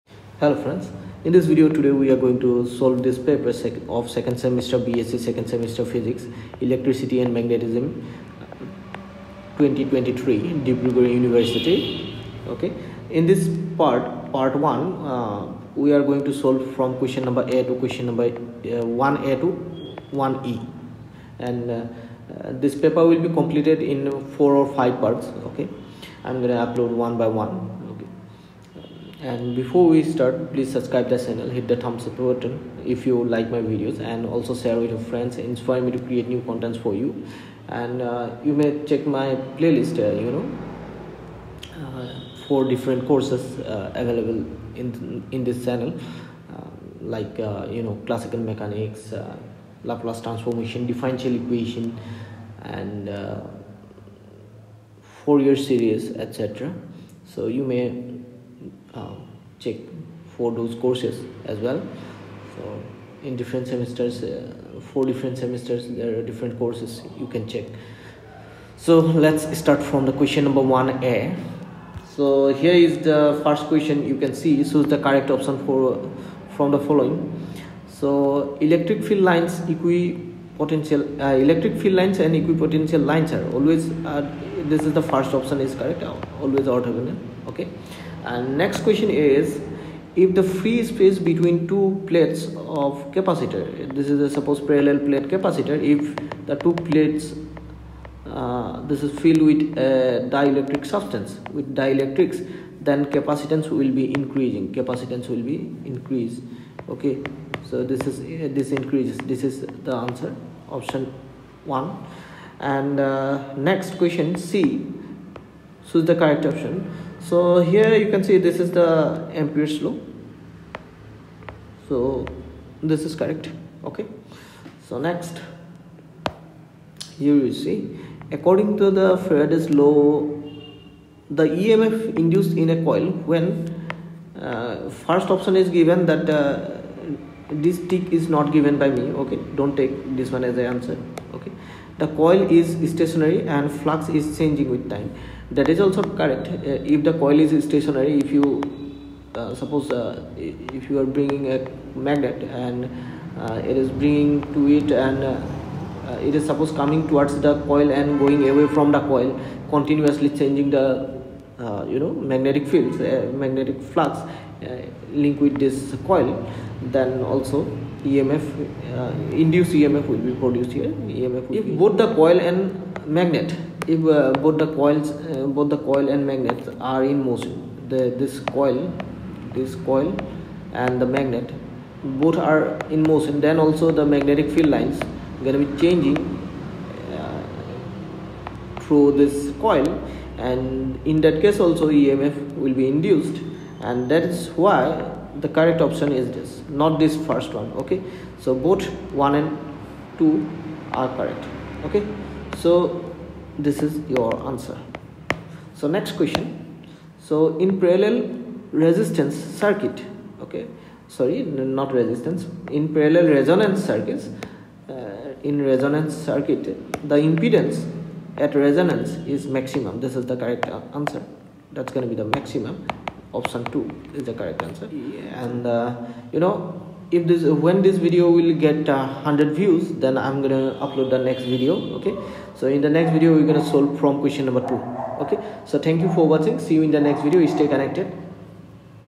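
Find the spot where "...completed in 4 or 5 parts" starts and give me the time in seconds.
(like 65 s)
23 s.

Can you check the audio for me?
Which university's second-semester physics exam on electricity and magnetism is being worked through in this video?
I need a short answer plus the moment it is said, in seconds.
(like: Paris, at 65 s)
Dibrugarh University, at 10 s.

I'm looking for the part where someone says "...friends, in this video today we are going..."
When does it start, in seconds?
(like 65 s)
0 s.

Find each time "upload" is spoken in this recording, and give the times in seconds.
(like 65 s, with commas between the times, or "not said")
26 s, 230 s.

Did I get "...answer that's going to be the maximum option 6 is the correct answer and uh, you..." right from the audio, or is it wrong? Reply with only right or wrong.
wrong.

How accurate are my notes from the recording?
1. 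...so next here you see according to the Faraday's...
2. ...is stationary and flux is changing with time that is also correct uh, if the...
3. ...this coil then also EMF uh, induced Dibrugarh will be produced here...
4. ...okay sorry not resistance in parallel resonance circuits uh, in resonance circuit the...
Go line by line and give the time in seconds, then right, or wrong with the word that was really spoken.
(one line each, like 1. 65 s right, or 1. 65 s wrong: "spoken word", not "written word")
1. 124 s right
2. 142 s right
3. 165 s wrong: "EMF", not "Dibrugarh"
4. 210 s right.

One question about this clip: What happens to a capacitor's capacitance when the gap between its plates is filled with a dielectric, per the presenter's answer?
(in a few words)
Increased.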